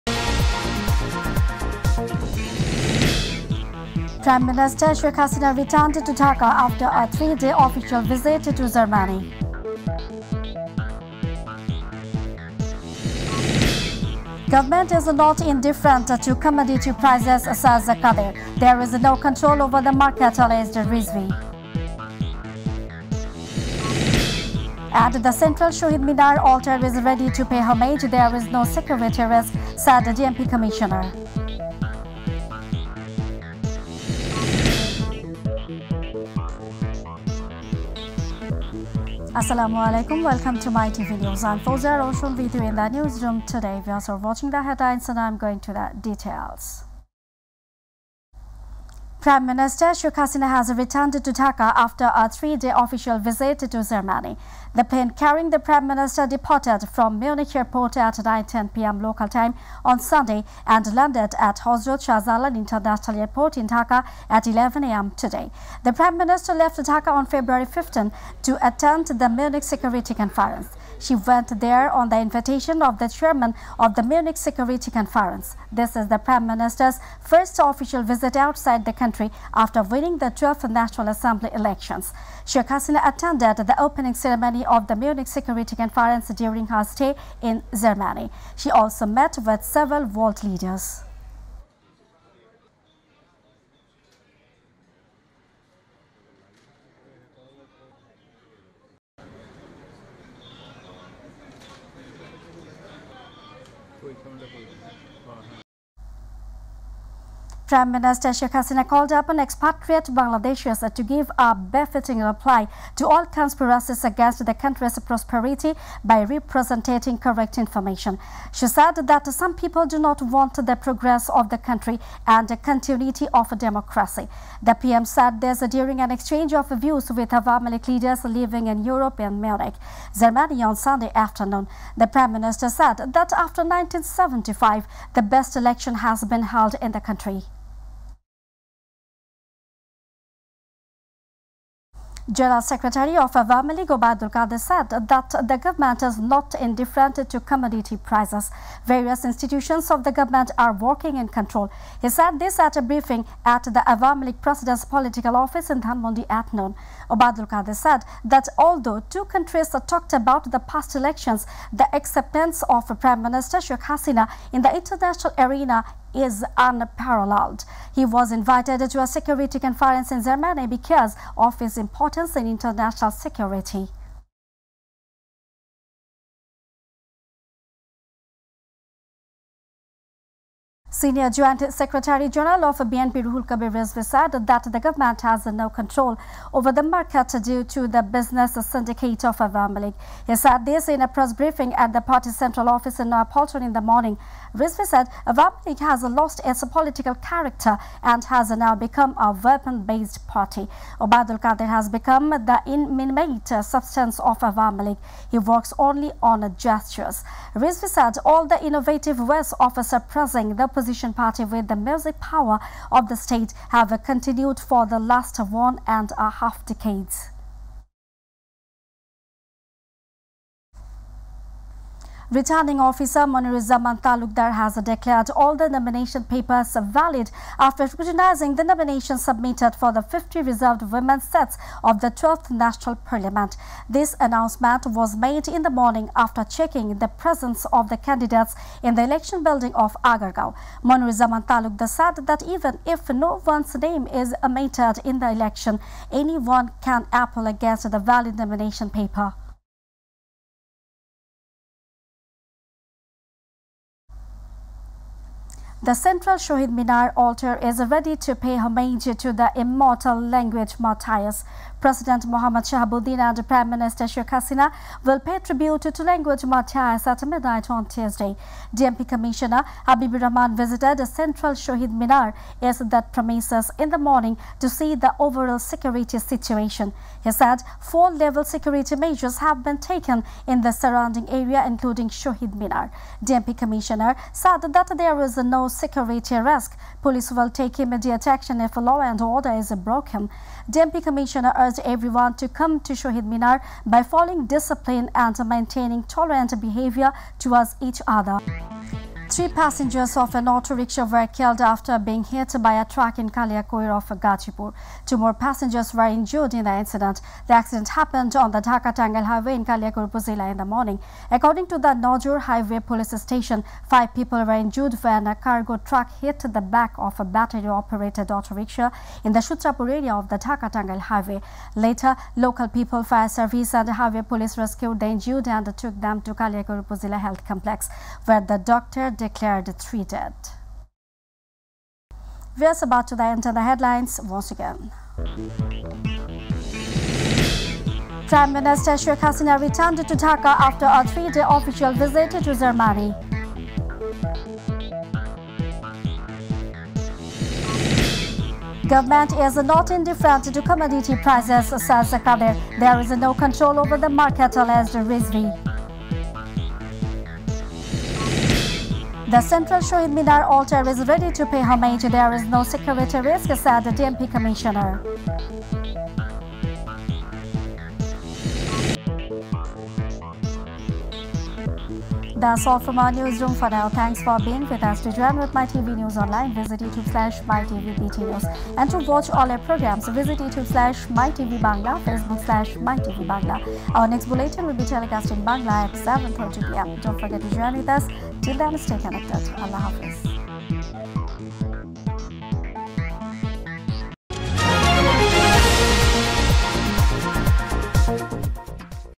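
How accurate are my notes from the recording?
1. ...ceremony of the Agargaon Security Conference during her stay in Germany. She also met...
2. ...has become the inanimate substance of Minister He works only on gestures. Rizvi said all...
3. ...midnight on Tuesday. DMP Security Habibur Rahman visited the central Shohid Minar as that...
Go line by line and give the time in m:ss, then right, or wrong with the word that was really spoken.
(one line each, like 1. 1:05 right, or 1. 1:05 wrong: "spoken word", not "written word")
1. 1:24 wrong: "Munich", not "Agargaon"
2. 3:21 wrong: "Awami", not "Minister"
3. 4:27 wrong: "Commissioner", not "Security".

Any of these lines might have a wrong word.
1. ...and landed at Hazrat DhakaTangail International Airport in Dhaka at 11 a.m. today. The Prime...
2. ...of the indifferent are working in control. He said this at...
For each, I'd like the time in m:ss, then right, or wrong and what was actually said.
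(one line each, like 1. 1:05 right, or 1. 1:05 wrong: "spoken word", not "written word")
1. 1:00 wrong: "Shahjalal", not "DhakaTangail"
2. 2:29 wrong: "government", not "indifferent".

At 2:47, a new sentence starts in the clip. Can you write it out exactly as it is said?
He was invited to a security conference in Germany because of his importance in international security.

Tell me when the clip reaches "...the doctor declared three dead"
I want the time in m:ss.
5:28.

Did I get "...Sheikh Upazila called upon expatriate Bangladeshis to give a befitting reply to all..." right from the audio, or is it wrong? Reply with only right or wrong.
wrong.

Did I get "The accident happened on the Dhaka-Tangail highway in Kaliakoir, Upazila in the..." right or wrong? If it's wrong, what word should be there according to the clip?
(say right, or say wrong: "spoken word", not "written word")
right.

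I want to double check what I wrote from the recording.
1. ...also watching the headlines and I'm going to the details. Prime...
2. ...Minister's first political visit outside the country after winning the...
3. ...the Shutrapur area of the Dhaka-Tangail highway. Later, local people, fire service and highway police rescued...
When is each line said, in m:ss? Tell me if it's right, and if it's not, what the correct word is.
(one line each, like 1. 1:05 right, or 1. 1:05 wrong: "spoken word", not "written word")
1. 0:43 right
2. 1:16 wrong: "official", not "political"
3. 5:19 right.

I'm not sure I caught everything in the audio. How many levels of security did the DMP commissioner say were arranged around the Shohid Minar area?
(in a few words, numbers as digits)
4.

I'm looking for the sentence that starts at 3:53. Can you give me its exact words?
This announcement was made in the morning after checking the presence of the candidates in the election building of Agargaon.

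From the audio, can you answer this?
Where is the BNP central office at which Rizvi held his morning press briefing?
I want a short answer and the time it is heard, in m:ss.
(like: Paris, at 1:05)
Polton, at 3:13.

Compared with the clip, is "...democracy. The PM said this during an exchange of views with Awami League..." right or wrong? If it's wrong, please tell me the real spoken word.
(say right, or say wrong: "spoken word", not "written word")
right.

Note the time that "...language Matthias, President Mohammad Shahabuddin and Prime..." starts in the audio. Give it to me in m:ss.
4:20.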